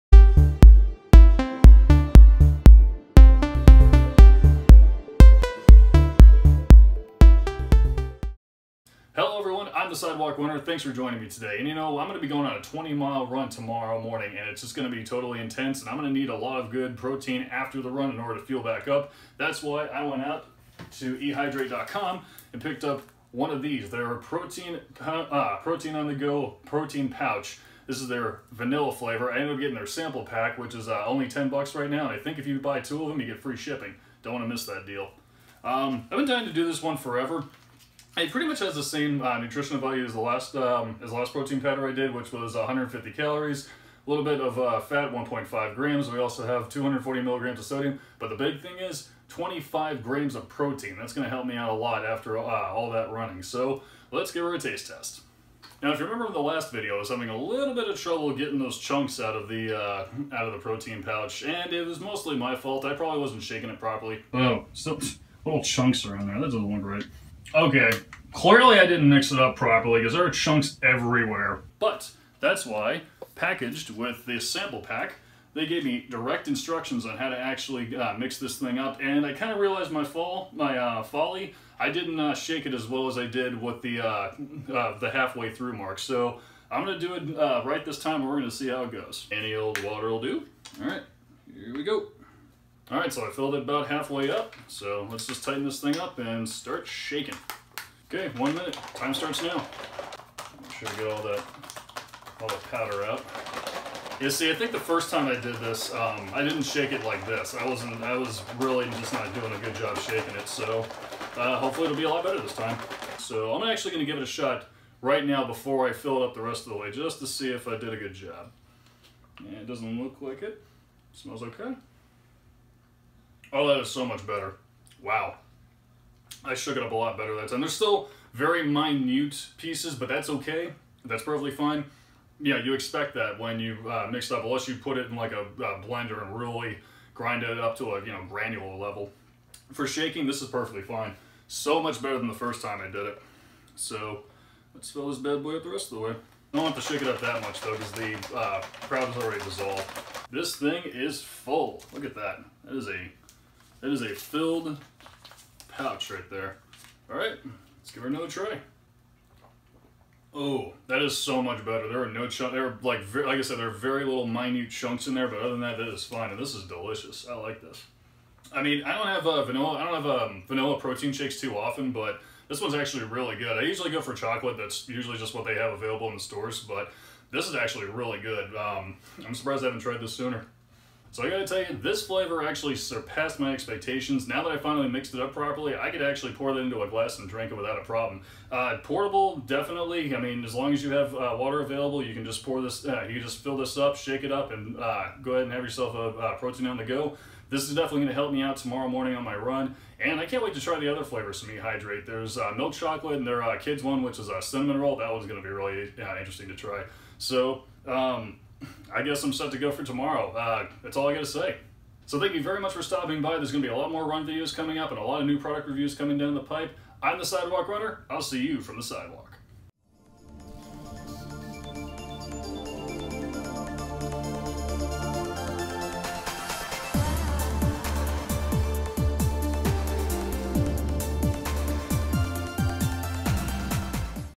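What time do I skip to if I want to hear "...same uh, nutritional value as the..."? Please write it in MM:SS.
00:38.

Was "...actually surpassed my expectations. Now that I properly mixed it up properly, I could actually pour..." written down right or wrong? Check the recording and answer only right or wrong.
wrong.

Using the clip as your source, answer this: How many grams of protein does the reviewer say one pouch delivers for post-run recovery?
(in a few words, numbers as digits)
25 grams.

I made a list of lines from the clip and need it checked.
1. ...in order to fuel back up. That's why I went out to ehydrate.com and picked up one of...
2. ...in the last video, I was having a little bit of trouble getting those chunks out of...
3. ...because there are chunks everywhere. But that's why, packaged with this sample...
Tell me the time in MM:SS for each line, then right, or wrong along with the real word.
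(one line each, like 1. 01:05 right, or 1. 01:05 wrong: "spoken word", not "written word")
1. 00:18 right
2. 00:56 right
3. 01:09 right.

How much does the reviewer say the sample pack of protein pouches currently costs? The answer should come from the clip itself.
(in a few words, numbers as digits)
$10.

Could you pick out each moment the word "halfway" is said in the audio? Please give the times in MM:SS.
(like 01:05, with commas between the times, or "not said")
01:25, 01:33.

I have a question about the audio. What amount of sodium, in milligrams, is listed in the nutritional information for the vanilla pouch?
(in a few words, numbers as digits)
240 milligrams.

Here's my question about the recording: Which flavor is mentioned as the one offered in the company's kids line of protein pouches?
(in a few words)
cinnamon roll.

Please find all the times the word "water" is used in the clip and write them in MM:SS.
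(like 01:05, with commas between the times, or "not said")
01:29, 03:11.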